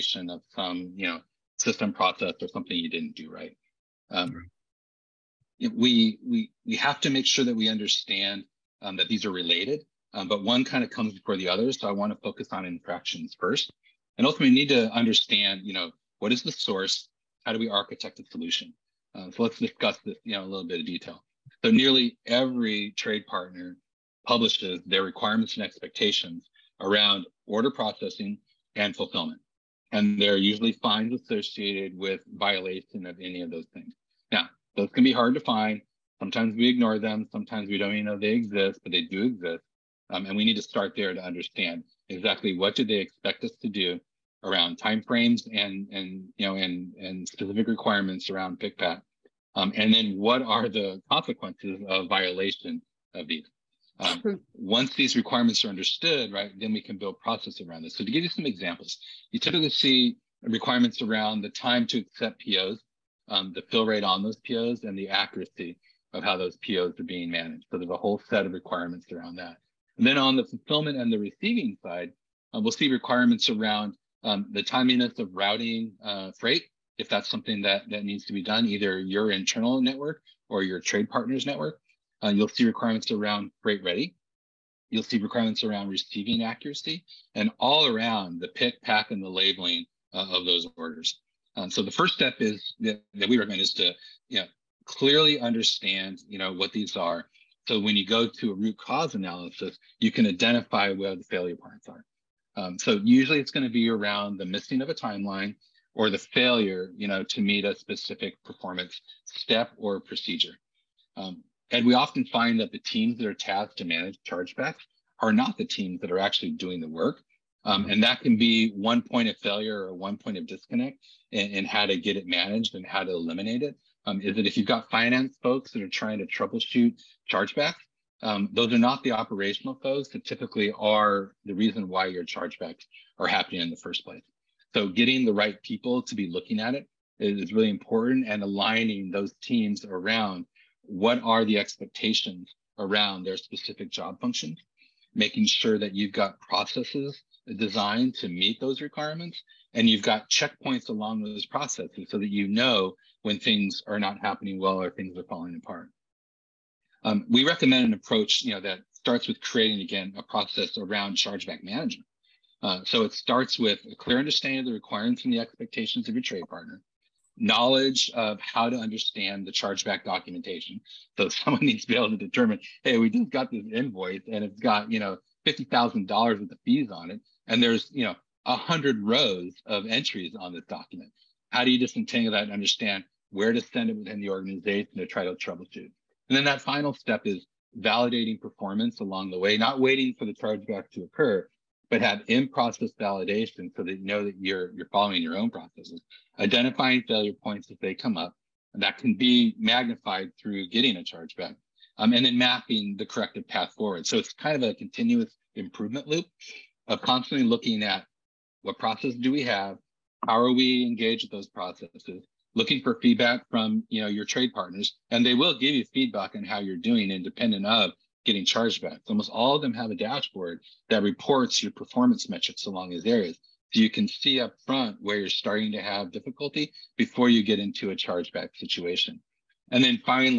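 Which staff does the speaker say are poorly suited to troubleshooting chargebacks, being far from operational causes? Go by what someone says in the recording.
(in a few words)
finance folks.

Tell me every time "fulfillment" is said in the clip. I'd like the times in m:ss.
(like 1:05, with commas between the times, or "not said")
0:28, 1:10.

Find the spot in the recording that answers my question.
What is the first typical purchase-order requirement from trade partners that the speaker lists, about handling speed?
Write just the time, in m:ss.
1:01.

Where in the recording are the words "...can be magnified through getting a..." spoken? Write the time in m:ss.
3:18.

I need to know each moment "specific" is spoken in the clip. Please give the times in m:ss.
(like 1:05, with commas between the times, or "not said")
0:47, 1:47, 2:23.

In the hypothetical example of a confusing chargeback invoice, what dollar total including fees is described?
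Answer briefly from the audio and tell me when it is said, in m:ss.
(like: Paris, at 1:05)
$50,000, at 2:55.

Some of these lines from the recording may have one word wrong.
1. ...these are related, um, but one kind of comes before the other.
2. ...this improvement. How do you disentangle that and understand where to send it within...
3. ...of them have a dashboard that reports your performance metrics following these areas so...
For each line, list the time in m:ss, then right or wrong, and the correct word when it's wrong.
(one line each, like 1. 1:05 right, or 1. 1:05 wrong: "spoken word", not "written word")
1. 0:09 right
2. 3:00 wrong: "document", not "improvement"
3. 3:39 wrong: "along", not "following".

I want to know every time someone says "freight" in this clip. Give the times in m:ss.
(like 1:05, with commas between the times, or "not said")
1:16, 1:23.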